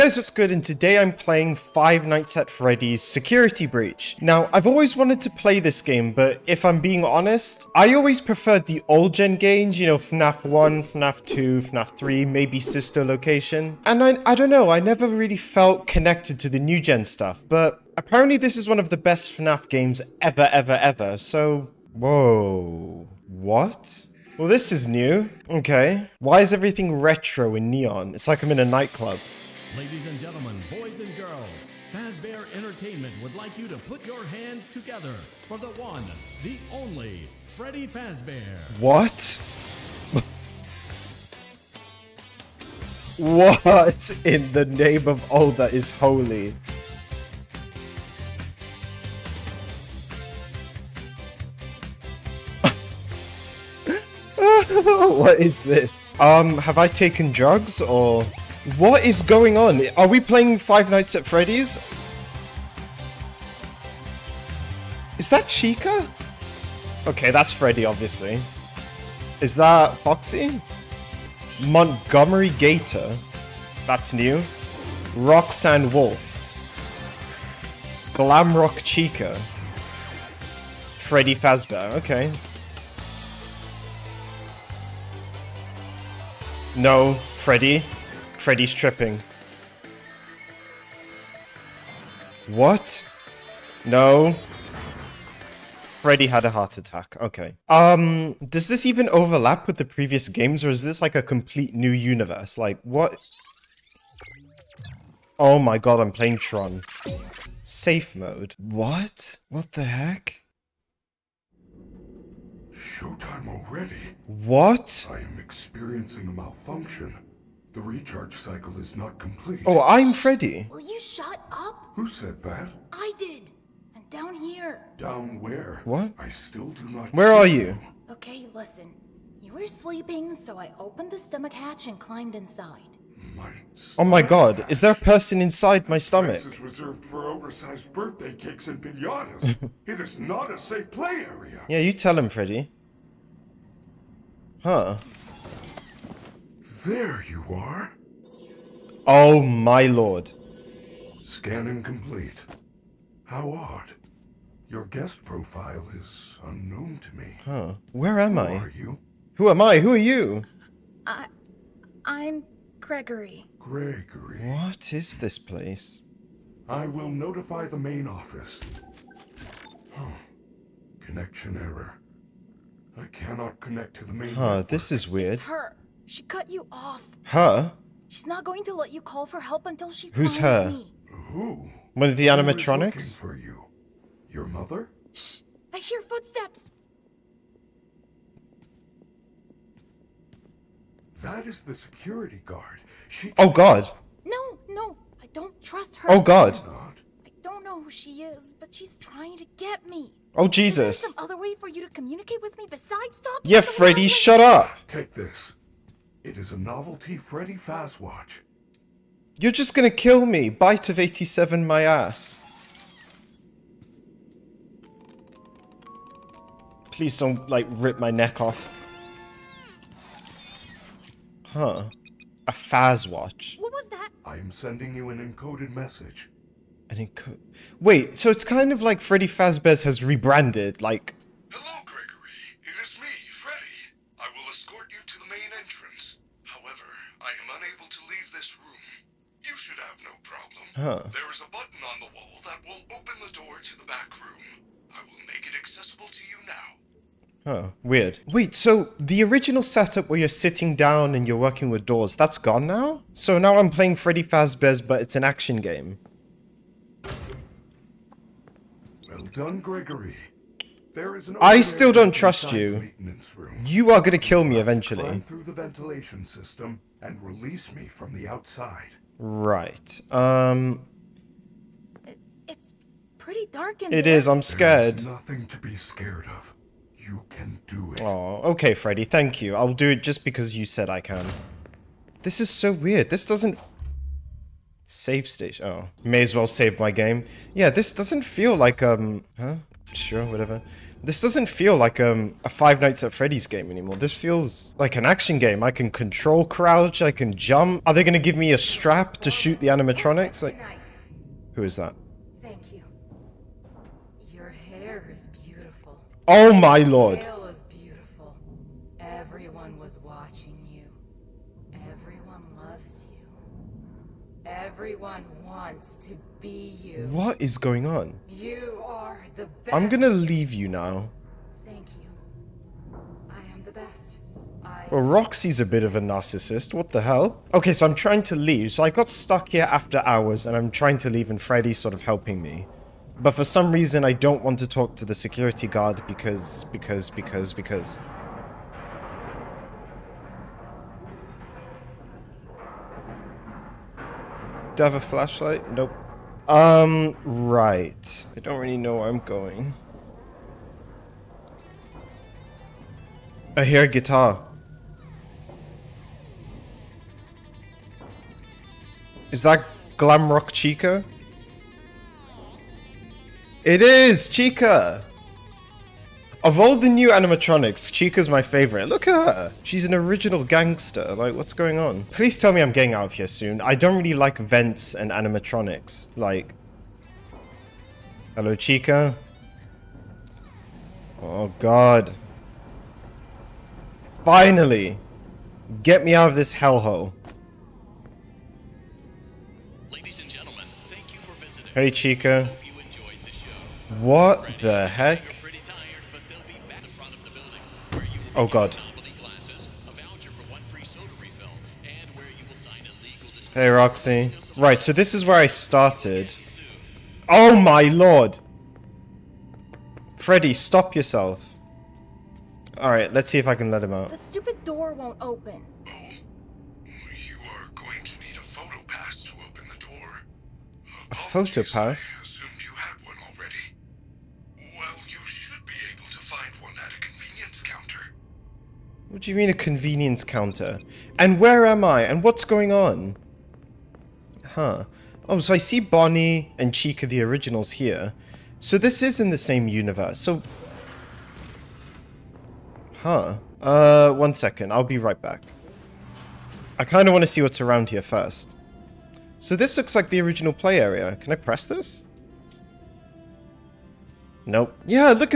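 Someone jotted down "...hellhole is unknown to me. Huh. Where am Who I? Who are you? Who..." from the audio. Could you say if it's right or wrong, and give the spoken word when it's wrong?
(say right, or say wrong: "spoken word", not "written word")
wrong: "profile", not "hellhole".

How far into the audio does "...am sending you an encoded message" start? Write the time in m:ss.
3:44.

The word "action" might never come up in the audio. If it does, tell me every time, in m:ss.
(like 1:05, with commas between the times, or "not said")
4:15, 4:55.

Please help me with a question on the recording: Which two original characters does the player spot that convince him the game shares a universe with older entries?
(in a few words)
Bonnie and Chica.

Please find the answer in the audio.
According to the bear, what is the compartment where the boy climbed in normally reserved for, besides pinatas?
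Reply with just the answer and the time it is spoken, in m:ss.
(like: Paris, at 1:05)
Oversized birthday cakes, at 2:17.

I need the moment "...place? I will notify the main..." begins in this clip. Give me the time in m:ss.
2:45.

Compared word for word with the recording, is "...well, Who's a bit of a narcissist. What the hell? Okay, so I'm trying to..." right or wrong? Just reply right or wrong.
wrong.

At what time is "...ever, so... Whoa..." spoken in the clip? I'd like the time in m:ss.
0:20.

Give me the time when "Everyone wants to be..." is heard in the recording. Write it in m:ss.
5:14.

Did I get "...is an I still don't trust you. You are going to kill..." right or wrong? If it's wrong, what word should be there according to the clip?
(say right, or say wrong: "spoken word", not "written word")
right.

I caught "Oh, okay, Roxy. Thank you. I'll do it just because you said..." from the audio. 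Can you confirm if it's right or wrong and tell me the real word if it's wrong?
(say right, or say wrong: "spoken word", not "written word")
wrong: "Freddy", not "Roxy".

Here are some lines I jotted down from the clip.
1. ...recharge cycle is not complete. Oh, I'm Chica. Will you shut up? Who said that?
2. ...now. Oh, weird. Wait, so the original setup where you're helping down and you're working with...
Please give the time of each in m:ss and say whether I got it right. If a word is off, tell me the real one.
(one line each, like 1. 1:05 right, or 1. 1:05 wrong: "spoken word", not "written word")
1. 1:57 wrong: "Freddy", not "Chica"
2. 4:06 wrong: "sitting", not "helping".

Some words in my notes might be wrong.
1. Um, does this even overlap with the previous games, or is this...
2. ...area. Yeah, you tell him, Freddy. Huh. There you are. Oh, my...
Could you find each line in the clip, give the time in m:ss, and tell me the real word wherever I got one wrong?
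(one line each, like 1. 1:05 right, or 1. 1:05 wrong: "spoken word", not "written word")
1. 1:37 right
2. 2:21 right.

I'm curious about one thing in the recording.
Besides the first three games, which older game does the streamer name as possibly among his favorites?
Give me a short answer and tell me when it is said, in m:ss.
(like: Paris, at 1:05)
Sister Location, at 0:12.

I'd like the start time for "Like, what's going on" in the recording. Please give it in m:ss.
6:11.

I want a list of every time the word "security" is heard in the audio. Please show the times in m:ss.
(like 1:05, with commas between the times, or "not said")
0:03, 3:11, 5:35.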